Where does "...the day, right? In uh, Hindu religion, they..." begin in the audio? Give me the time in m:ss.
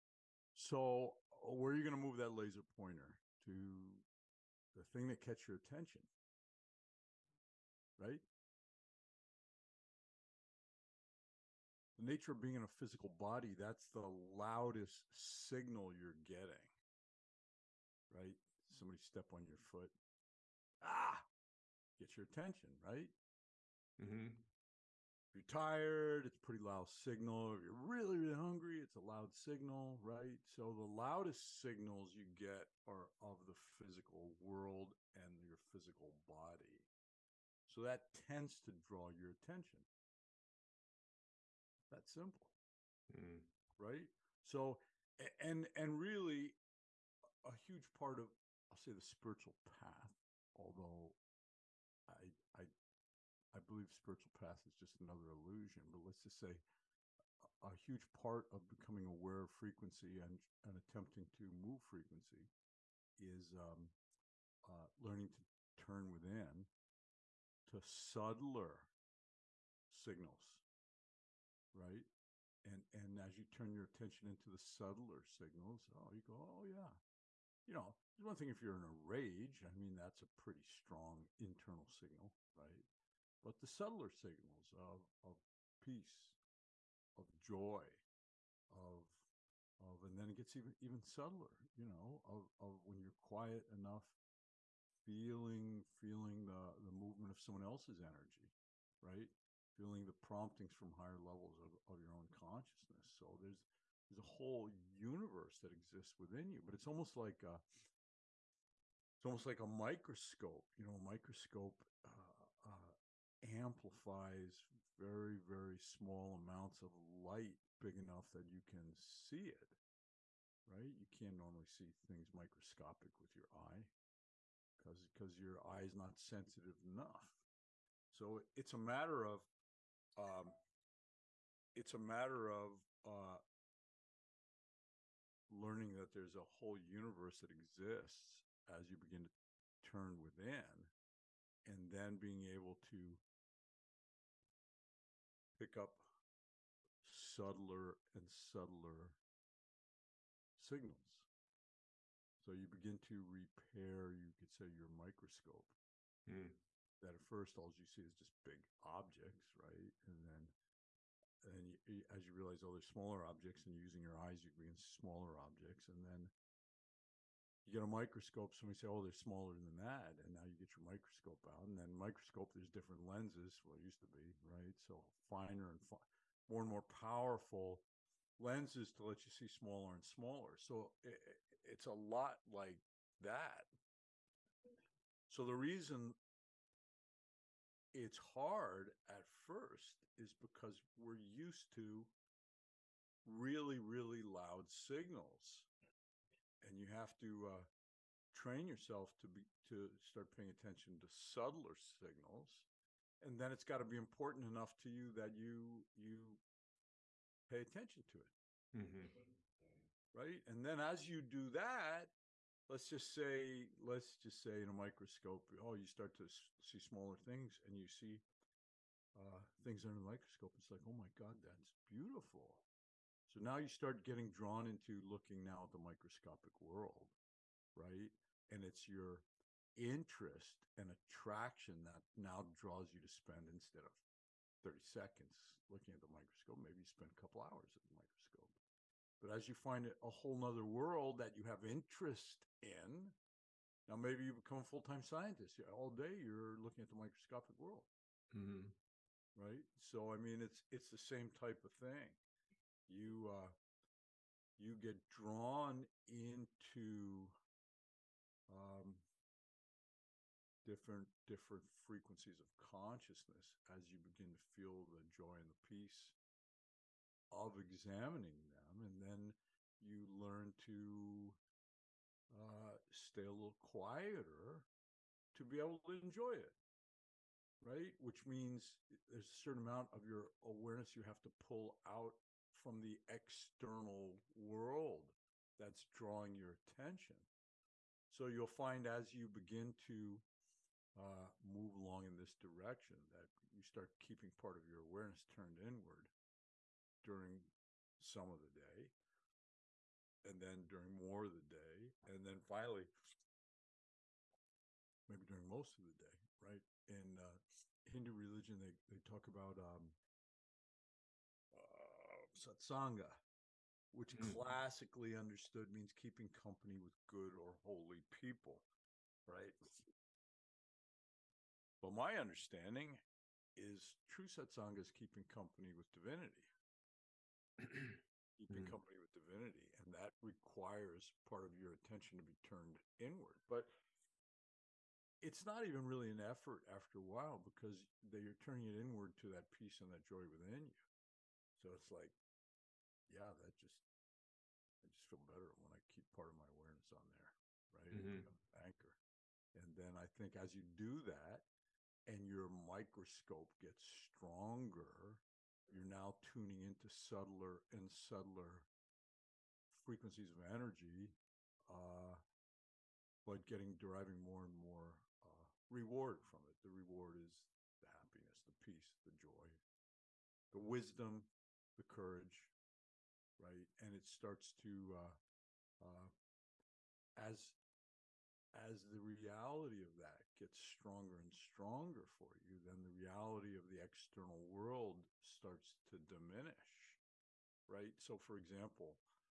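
5:05.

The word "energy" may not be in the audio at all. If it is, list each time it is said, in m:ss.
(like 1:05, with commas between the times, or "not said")
1:38, 6:00.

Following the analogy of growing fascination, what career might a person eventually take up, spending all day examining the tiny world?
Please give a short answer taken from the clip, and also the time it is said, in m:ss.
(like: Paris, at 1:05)
Full time scientist, at 4:04.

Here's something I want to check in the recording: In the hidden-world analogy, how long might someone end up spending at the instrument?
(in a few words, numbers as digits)
A couple hours.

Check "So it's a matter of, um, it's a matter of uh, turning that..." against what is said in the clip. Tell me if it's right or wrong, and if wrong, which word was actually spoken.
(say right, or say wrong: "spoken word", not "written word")
wrong: "learning", not "turning".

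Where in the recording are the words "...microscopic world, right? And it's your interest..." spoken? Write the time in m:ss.
3:45.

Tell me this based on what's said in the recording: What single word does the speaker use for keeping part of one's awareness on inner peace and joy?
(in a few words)
Anchor.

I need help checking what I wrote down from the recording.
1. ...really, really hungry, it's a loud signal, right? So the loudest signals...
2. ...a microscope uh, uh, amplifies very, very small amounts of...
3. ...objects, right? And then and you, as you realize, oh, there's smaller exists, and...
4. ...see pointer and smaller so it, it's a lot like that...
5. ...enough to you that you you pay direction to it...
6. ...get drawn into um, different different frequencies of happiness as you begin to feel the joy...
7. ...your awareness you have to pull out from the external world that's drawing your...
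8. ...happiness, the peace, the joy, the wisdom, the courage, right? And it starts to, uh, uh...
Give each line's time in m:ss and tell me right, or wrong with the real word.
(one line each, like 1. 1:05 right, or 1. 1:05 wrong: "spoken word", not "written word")
1. 0:27 right
2. 1:50 right
3. 2:38 wrong: "objects", not "exists"
4. 2:59 wrong: "smaller", not "pointer"
5. 3:24 wrong: "attention", not "direction"
6. 4:14 wrong: "consciousness", not "happiness"
7. 4:40 right
8. 6:07 right.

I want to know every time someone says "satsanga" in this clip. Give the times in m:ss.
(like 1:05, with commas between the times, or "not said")
5:12, 5:24.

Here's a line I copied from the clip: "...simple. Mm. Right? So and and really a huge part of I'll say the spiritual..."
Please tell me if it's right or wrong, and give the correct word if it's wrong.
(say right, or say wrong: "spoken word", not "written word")
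right.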